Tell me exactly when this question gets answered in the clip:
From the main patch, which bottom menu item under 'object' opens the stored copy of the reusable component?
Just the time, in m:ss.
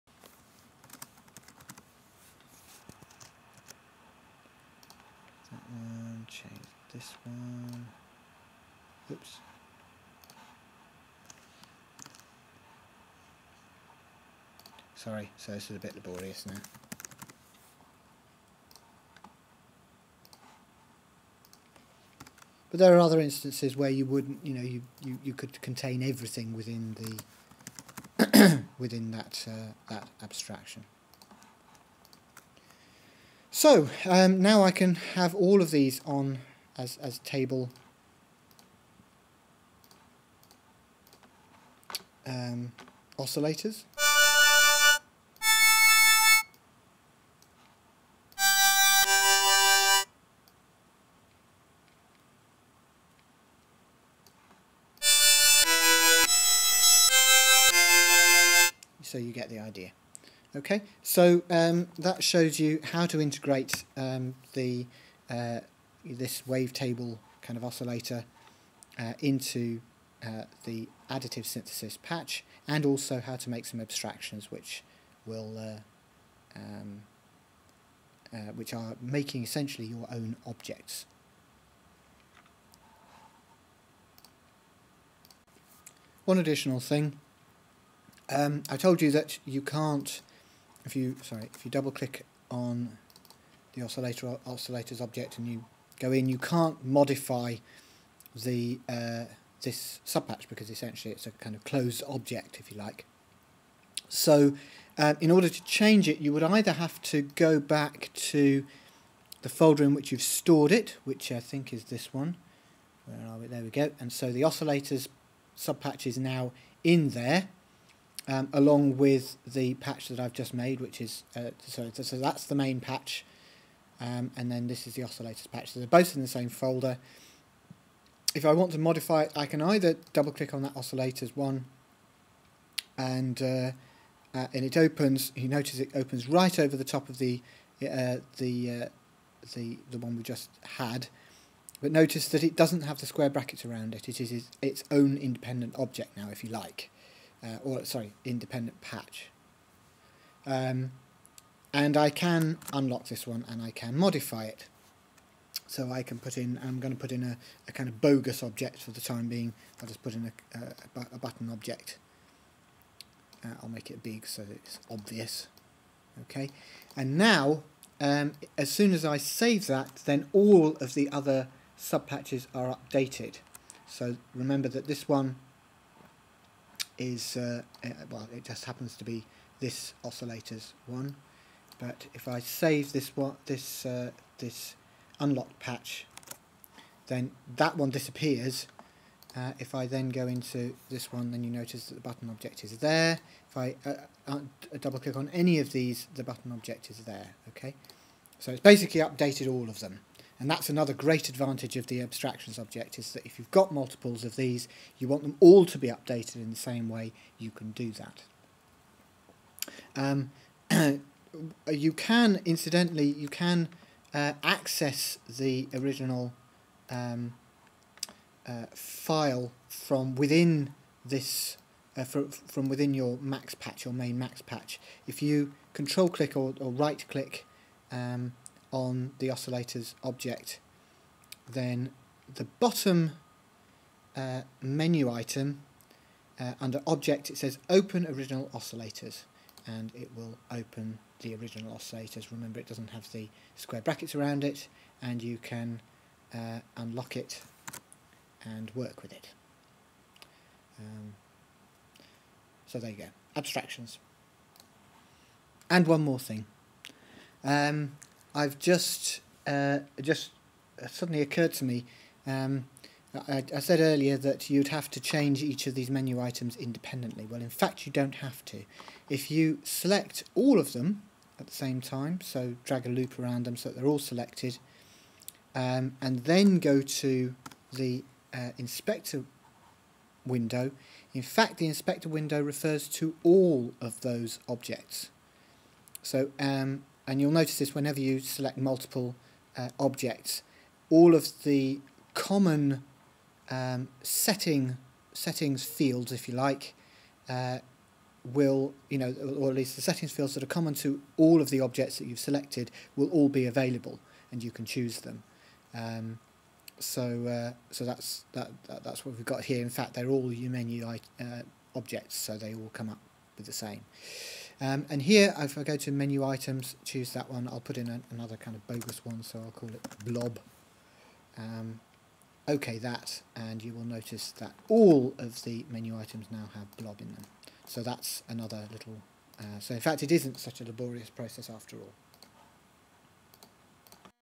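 3:57.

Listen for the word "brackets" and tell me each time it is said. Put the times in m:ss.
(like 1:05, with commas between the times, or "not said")
2:23, 4:03.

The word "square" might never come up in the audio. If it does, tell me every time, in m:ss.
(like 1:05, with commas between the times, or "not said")
2:23, 4:03.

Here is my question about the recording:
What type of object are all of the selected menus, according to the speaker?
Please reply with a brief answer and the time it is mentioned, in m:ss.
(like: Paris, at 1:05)
UMenu, at 5:10.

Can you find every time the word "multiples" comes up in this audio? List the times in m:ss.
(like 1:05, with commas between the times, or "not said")
3:23, 4:48.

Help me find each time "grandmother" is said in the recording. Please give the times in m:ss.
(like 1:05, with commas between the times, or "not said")
not said.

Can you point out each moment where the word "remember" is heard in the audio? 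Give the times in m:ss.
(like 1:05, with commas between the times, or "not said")
2:54, 4:02.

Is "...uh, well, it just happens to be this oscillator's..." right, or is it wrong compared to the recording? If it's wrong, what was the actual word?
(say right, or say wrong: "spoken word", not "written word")
right.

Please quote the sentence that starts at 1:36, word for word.
You can't modify the uh, this subpatch because essentially it's a kind of closed object, if you like.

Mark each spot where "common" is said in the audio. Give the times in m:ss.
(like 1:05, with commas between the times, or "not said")
4:52, 5:00.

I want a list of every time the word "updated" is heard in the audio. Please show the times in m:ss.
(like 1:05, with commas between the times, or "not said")
2:52, 3:19, 3:25.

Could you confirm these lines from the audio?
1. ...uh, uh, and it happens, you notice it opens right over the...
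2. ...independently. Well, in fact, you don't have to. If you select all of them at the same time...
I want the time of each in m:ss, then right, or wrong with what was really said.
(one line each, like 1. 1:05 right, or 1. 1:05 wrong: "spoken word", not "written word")
1. 2:13 wrong: "opens", not "happens"
2. 4:26 right.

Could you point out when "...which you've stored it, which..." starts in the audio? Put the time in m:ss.
1:49.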